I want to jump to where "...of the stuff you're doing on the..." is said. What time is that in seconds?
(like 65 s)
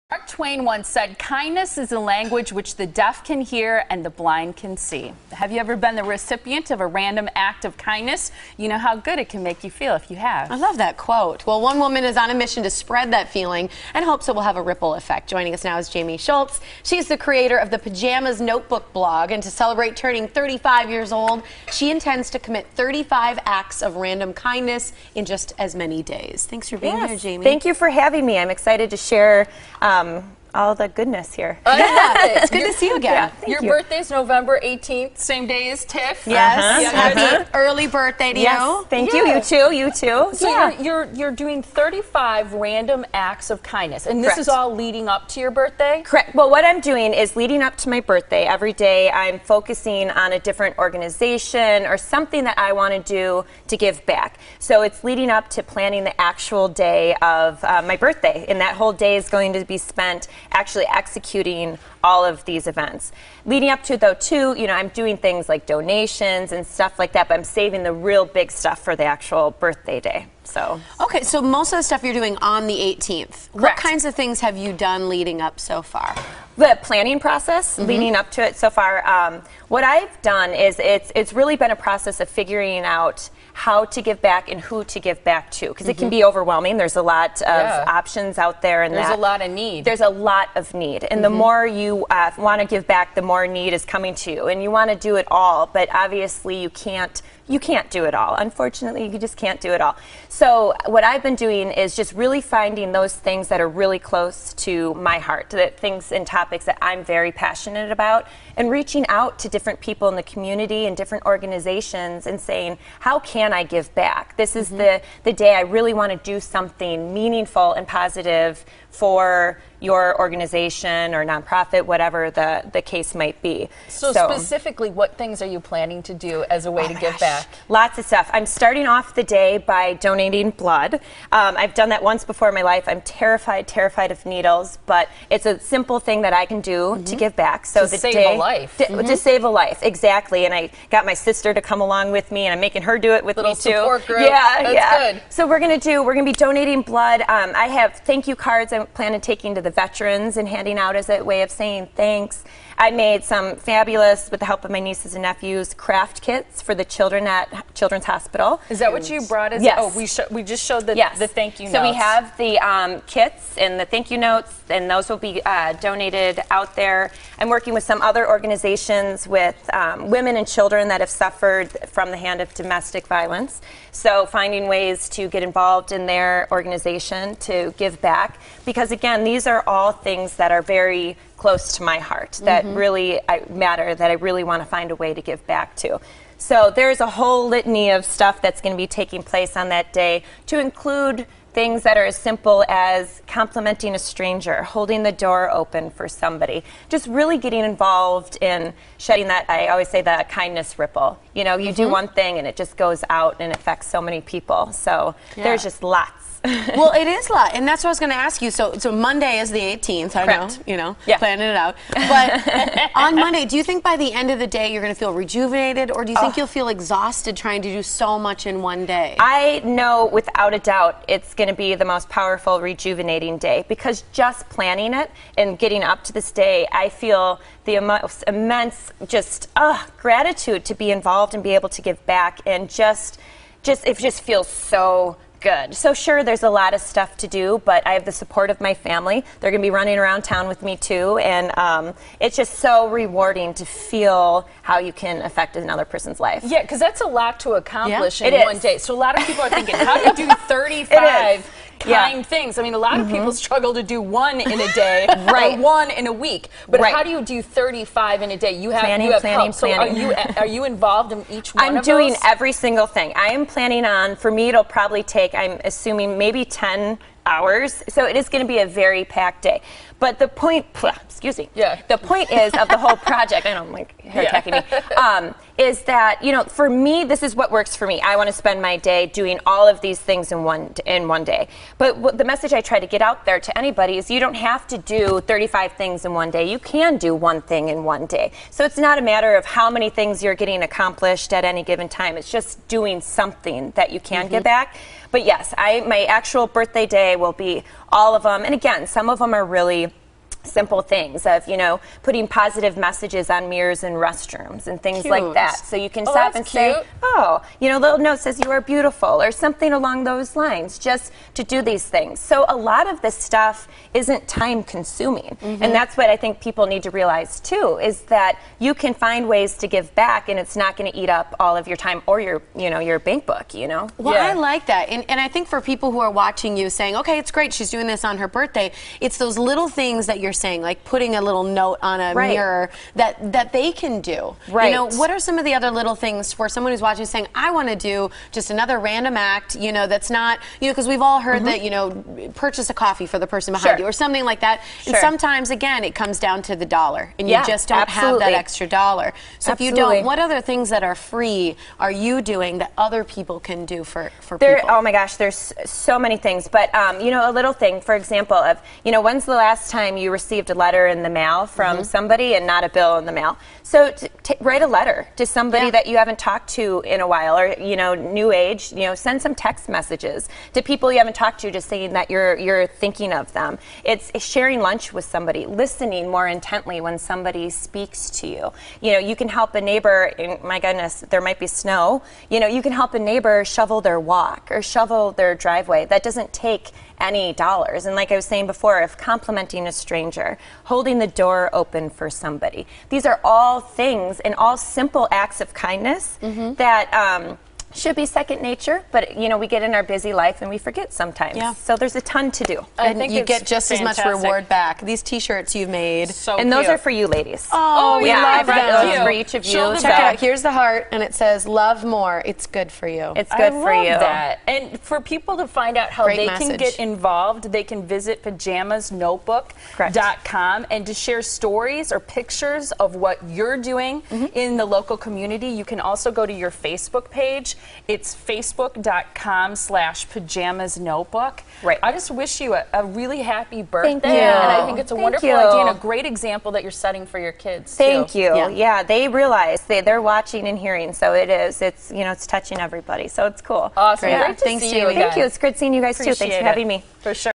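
71 s.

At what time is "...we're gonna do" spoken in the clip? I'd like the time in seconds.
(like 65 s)
145 s.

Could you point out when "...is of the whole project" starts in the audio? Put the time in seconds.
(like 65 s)
272 s.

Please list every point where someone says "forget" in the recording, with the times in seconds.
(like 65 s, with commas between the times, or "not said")
400 s.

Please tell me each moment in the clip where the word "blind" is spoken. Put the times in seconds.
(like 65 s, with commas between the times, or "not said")
4 s.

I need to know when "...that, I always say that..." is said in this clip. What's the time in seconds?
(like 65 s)
199 s.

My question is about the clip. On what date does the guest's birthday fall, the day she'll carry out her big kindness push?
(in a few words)
November 18th.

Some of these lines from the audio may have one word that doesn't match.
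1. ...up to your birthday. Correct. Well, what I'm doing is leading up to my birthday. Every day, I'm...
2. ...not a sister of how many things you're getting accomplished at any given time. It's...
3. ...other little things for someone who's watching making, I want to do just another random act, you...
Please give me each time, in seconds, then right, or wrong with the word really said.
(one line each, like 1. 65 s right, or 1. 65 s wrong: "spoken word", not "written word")
1. 45 s right
2. 288 s wrong: "matter", not "sister"
3. 335 s wrong: "saying", not "making".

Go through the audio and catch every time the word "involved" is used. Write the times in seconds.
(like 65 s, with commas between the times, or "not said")
175 s, 197 s, 230 s, 260 s, 416 s.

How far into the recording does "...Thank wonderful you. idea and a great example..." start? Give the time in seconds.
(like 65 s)
434 s.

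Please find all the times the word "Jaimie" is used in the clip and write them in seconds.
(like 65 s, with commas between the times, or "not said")
15 s, 27 s.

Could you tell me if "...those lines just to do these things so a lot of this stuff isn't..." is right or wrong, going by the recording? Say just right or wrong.
right.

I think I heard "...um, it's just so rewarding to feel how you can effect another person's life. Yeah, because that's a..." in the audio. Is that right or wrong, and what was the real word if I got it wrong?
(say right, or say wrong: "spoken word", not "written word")
wrong: "affect", not "effect".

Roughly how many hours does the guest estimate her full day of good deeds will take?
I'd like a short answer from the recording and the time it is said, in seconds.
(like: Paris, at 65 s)
10 hours, at 266 s.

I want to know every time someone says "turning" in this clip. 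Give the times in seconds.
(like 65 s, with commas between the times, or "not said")
19 s.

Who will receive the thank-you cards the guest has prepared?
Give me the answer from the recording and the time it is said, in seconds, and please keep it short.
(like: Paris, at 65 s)
Veterans, at 149 s.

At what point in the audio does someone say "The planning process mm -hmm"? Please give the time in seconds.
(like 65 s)
76 s.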